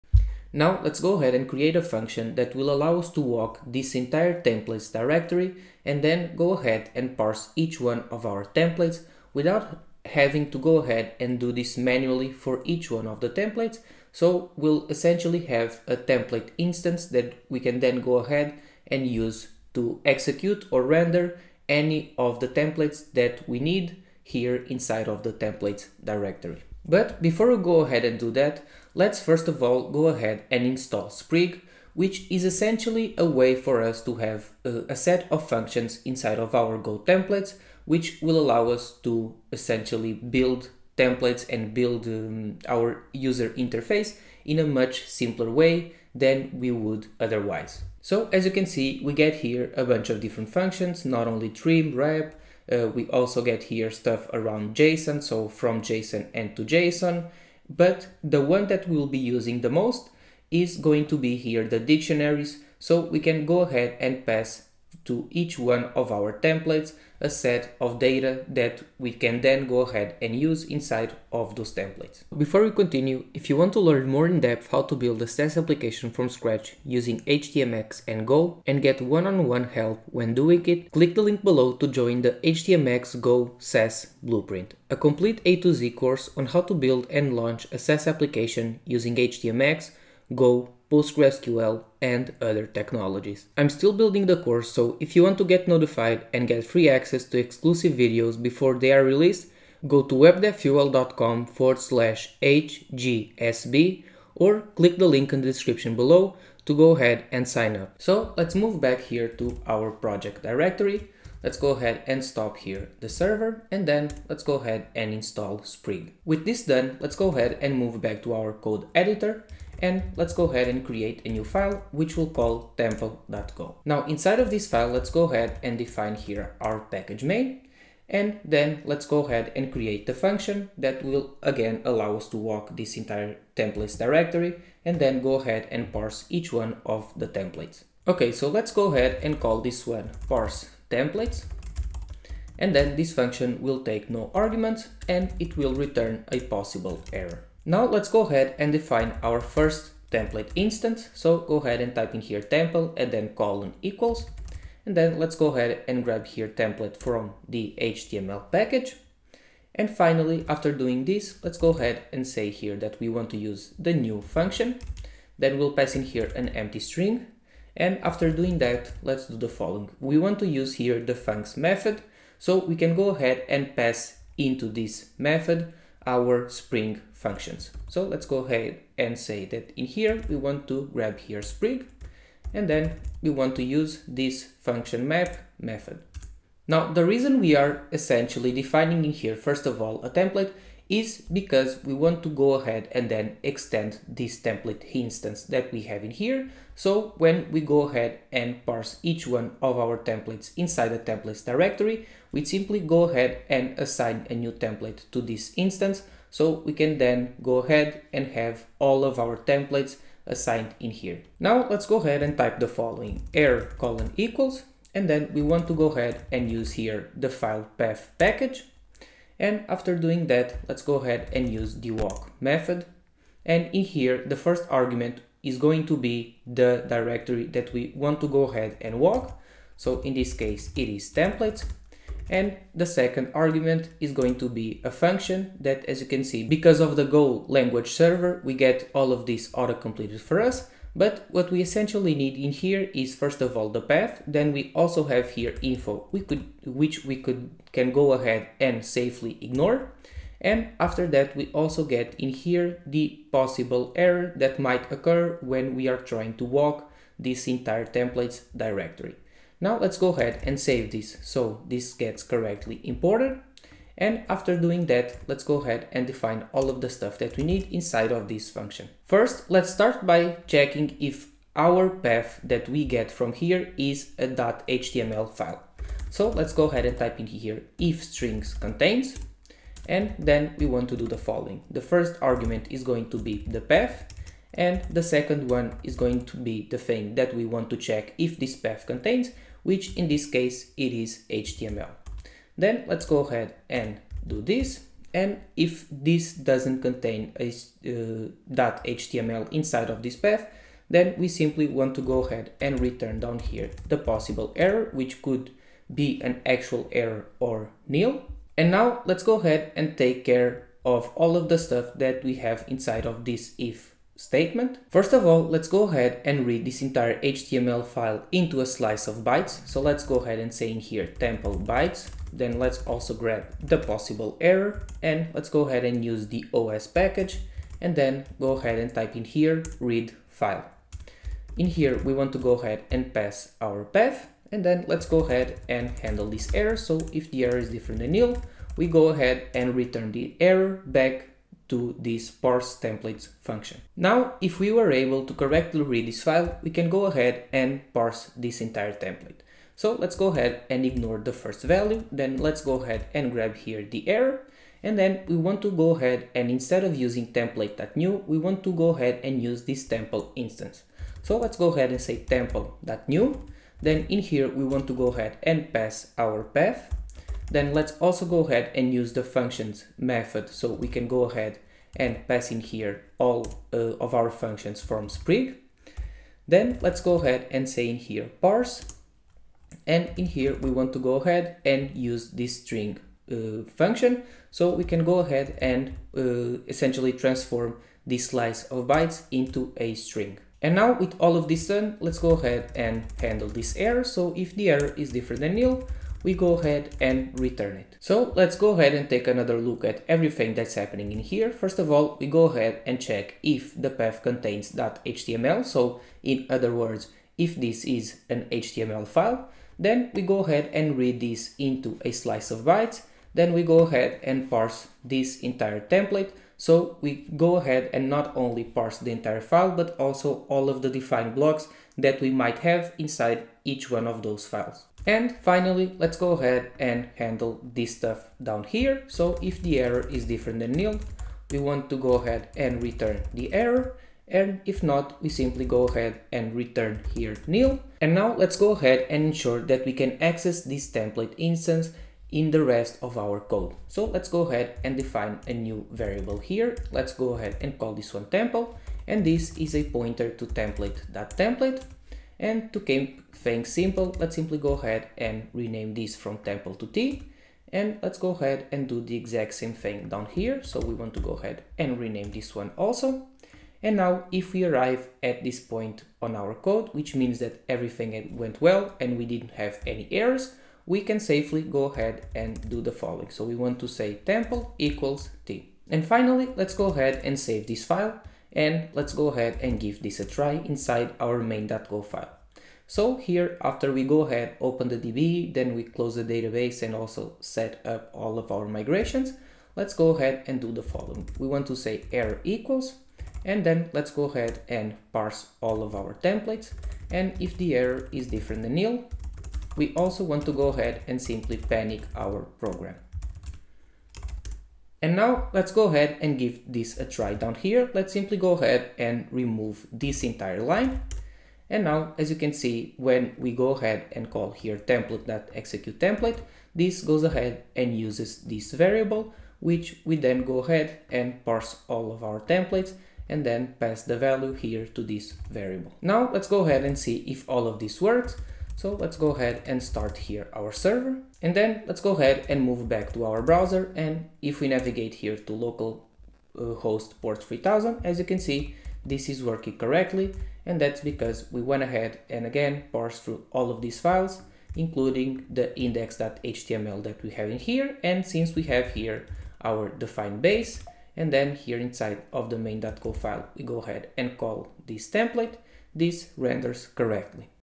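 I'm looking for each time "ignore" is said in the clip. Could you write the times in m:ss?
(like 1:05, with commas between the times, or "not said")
4:09, 5:50.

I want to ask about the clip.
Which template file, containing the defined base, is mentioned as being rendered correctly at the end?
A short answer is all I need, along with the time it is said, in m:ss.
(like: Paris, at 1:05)
index.html, at 9:05.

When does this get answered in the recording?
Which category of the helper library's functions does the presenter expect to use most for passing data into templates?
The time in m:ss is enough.
1:01.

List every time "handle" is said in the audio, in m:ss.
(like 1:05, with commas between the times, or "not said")
5:35, 6:33, 7:07.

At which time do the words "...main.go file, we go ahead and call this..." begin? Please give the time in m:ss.
9:12.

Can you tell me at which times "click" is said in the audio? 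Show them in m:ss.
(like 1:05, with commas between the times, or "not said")
1:20, 1:44.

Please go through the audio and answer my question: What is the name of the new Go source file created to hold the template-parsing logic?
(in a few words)
tempo.go.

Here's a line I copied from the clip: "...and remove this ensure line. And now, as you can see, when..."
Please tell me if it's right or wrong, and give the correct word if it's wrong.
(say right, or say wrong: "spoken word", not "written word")
wrong: "entire", not "ensure".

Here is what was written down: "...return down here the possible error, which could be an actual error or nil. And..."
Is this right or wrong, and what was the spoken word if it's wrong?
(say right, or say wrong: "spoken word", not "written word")
right.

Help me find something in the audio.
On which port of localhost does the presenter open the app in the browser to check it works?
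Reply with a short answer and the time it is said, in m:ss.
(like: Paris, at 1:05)
3000, at 8:57.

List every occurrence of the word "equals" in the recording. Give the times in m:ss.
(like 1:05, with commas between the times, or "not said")
2:33, 3:34, 7:54, 8:12.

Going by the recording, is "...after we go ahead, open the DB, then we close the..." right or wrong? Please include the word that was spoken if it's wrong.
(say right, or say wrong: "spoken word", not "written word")
right.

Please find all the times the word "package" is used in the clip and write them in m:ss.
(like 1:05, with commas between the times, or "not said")
2:06, 2:38, 3:38, 5:26.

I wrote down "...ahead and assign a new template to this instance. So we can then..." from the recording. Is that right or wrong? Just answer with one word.
right.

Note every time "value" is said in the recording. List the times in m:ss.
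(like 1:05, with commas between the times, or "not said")
5:51, 8:44.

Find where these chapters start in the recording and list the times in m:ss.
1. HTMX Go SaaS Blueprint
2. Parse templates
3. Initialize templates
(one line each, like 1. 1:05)
1. 1:12
2. 1:56
3. 7:55.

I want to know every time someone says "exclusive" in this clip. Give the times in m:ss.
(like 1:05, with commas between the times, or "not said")
1:37.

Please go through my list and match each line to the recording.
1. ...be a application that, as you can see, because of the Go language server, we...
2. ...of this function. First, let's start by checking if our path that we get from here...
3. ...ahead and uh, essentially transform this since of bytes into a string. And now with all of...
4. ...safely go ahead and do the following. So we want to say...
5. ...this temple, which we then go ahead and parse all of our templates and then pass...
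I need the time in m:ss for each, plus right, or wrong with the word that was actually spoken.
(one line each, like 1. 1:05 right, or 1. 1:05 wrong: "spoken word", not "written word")
1. 3:54 wrong: "function", not "application"
2. 4:28 right
3. 6:25 wrong: "slice", not "since"
4. 7:51 right
5. 8:38 wrong: "variable", not "temple".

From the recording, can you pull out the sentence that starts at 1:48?
So let's move back here to our project directory.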